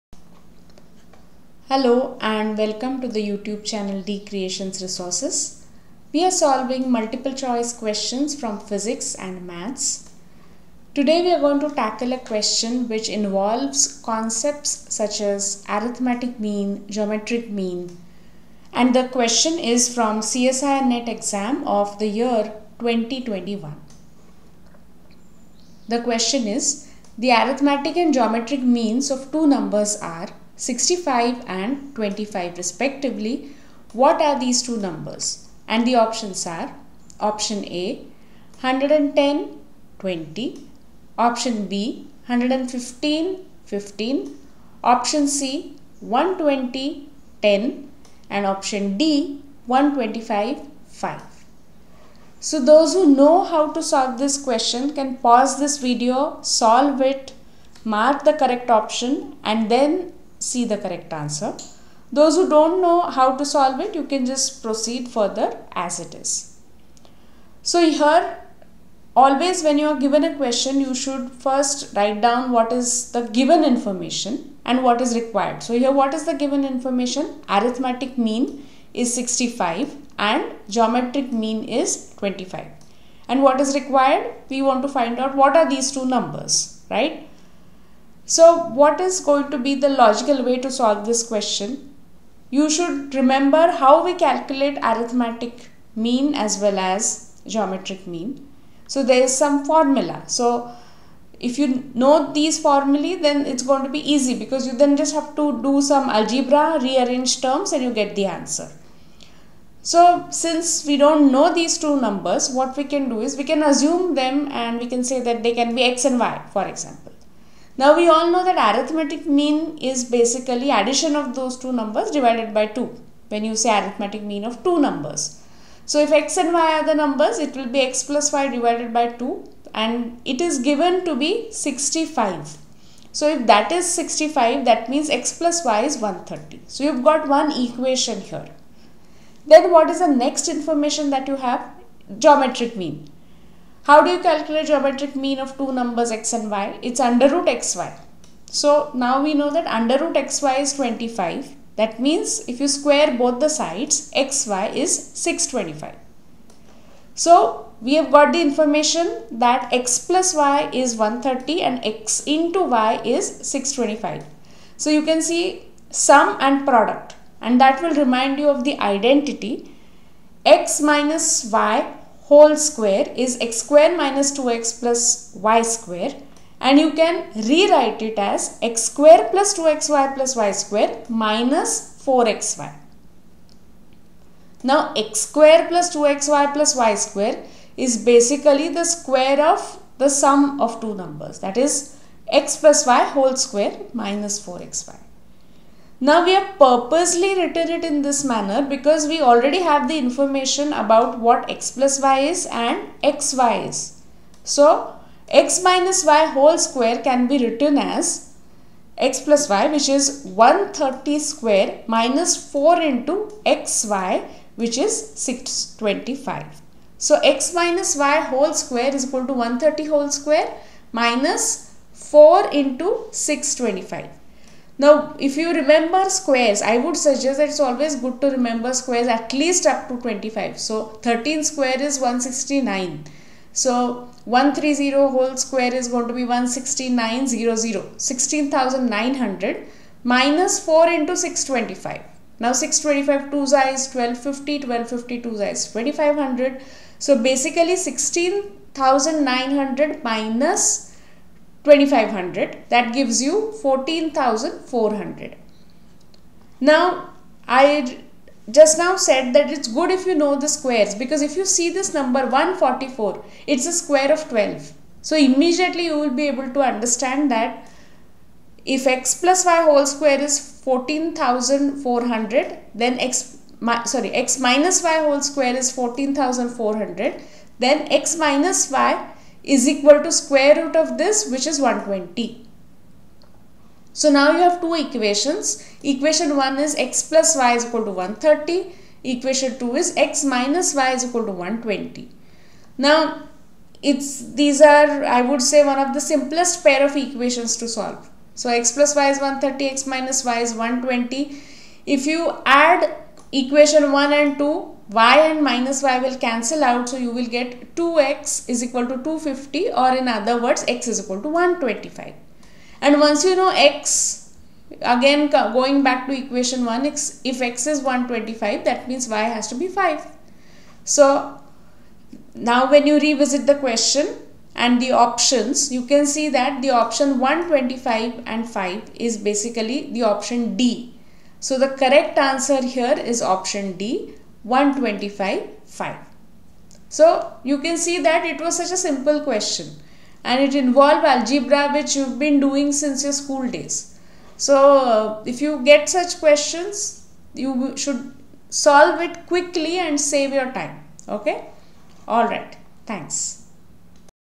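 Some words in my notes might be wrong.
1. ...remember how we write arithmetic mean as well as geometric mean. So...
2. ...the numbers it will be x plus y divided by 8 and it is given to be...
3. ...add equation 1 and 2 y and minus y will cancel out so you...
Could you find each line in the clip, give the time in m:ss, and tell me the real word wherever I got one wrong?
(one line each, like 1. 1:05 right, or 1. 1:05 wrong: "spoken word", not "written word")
1. 1:33 wrong: "calculate", not "write"
2. 2:06 wrong: "2", not "8"
3. 5:02 right.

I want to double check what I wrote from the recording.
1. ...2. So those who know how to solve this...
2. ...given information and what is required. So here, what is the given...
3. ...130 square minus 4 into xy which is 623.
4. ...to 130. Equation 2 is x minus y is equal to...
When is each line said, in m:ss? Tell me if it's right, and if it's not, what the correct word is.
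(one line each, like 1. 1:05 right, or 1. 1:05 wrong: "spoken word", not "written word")
1. 0:50 wrong: "5", not "2"
2. 1:13 right
3. 3:30 wrong: "625", not "623"
4. 4:47 right.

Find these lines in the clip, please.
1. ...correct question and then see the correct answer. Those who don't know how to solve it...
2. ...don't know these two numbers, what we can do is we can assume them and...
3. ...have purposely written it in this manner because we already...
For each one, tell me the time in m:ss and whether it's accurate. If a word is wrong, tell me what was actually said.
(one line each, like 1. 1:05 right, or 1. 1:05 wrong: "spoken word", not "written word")
1. 0:58 wrong: "option", not "question"
2. 1:50 right
3. 3:16 right.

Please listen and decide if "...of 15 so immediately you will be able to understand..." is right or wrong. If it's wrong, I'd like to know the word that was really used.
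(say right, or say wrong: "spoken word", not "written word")
wrong: "12", not "15".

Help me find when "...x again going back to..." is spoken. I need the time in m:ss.
5:13.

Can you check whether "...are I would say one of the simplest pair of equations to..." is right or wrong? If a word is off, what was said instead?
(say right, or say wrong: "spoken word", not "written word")
right.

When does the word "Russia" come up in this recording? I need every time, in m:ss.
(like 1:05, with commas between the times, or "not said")
not said.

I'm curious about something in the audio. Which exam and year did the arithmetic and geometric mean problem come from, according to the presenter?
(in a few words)
CSIR NET 2021.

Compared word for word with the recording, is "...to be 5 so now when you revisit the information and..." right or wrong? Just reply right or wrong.
wrong.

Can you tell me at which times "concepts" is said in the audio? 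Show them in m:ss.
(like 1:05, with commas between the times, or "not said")
0:14.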